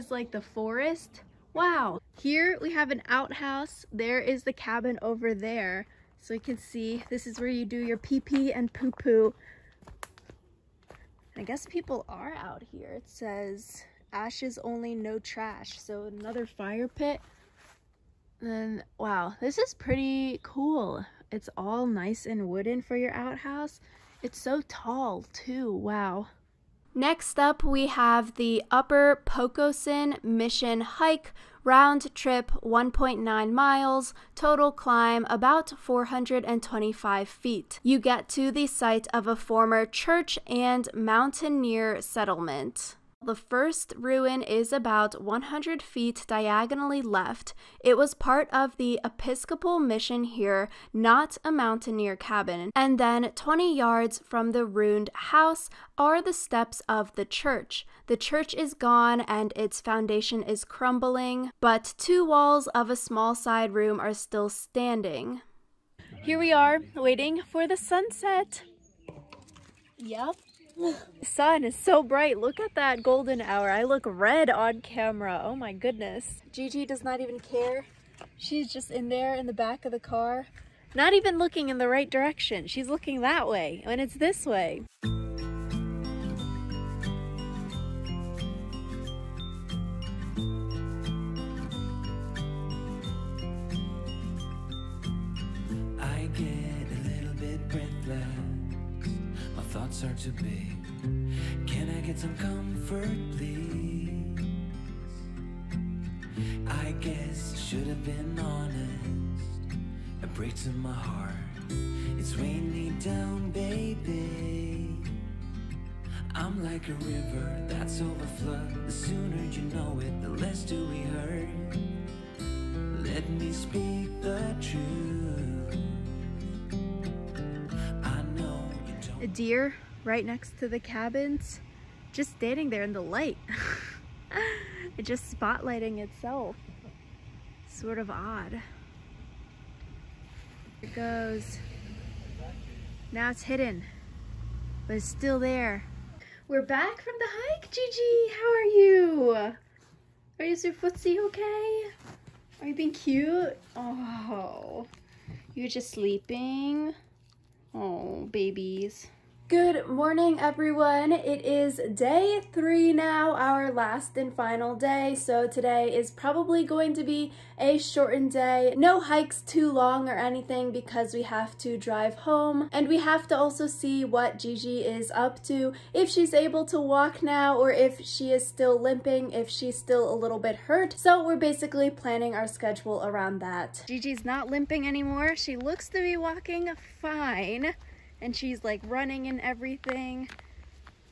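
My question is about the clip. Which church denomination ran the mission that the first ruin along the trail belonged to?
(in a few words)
Episcopal.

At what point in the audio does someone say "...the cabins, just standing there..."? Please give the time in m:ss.
2:10.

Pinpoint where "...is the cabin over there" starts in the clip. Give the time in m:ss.
0:04.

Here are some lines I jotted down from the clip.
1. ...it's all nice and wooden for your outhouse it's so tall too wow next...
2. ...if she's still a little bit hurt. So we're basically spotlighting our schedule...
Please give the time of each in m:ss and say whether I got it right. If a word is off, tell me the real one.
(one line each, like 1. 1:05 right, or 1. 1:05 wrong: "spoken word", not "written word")
1. 0:21 right
2. 2:59 wrong: "planning", not "spotlighting".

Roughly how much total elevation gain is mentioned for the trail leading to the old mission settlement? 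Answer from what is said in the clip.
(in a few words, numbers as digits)
425 feet.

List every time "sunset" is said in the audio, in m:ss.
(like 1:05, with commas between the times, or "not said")
1:07.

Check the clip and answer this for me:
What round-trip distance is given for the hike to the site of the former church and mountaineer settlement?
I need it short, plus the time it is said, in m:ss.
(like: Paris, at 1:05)
1.9 miles, at 0:32.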